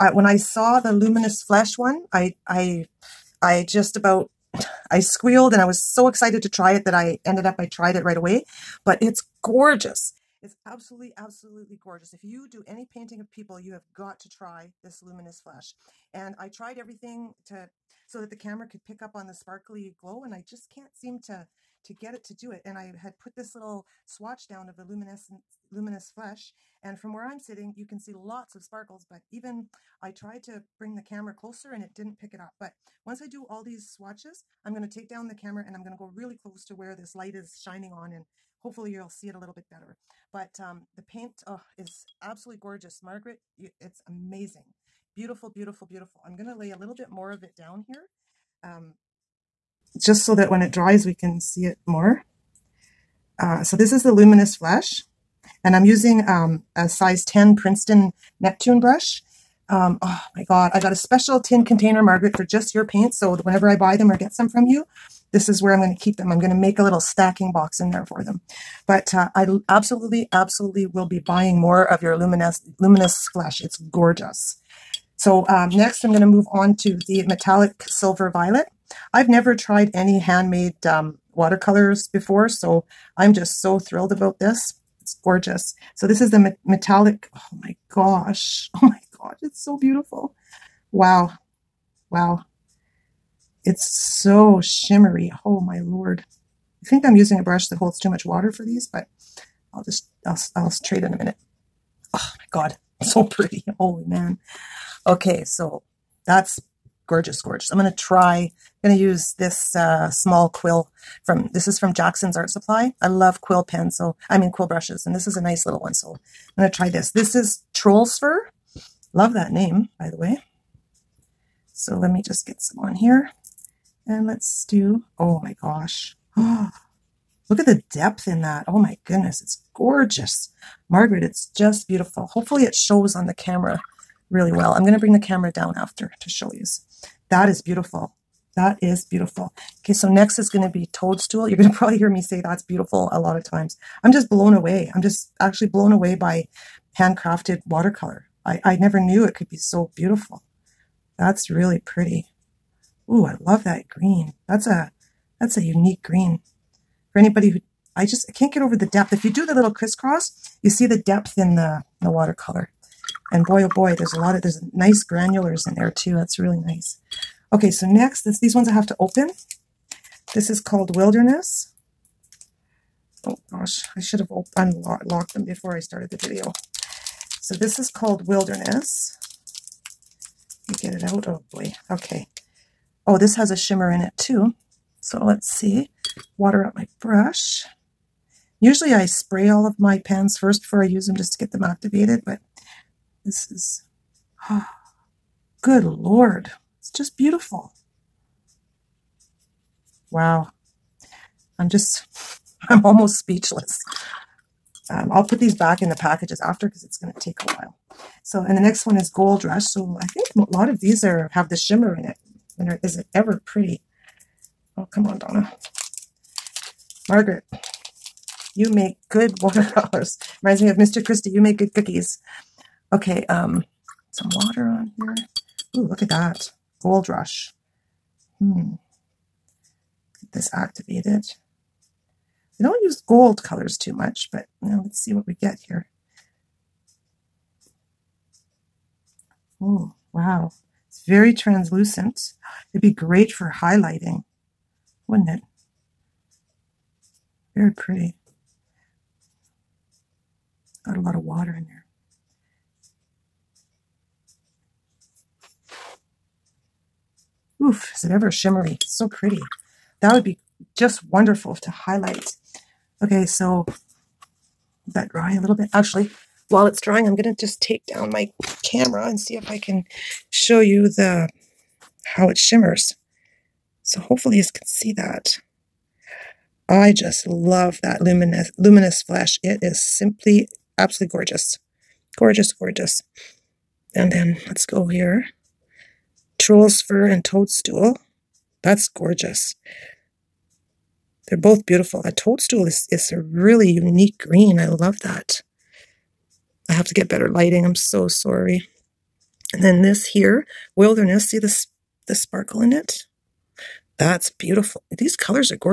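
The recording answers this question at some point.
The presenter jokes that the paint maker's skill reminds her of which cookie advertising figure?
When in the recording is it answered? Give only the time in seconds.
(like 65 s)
220 s.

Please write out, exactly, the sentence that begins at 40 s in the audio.
But um, the paint oh, is absolutely gorgeous.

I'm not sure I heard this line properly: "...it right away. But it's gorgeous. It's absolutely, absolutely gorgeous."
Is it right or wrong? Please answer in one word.
right.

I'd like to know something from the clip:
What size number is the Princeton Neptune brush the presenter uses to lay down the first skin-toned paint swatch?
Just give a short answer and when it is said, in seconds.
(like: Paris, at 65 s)
10, at 56 s.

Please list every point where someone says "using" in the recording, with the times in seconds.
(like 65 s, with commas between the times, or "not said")
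55 s, 97 s.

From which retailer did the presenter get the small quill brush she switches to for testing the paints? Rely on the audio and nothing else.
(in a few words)
Jackson's Art Supply.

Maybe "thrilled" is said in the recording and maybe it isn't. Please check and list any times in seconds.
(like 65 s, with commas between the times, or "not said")
83 s.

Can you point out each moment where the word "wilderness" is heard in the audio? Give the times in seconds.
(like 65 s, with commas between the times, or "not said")
170 s, 178 s, 300 s.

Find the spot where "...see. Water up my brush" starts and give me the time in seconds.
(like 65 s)
185 s.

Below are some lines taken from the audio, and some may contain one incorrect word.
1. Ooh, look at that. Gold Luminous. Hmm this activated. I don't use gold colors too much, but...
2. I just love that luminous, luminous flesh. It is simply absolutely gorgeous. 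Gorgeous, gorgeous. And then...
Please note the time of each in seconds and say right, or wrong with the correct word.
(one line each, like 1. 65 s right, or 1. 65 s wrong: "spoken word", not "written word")
1. 225 s wrong: "Rush", not "Luminous"
2. 276 s right.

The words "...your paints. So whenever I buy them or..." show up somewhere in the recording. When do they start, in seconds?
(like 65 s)
62 s.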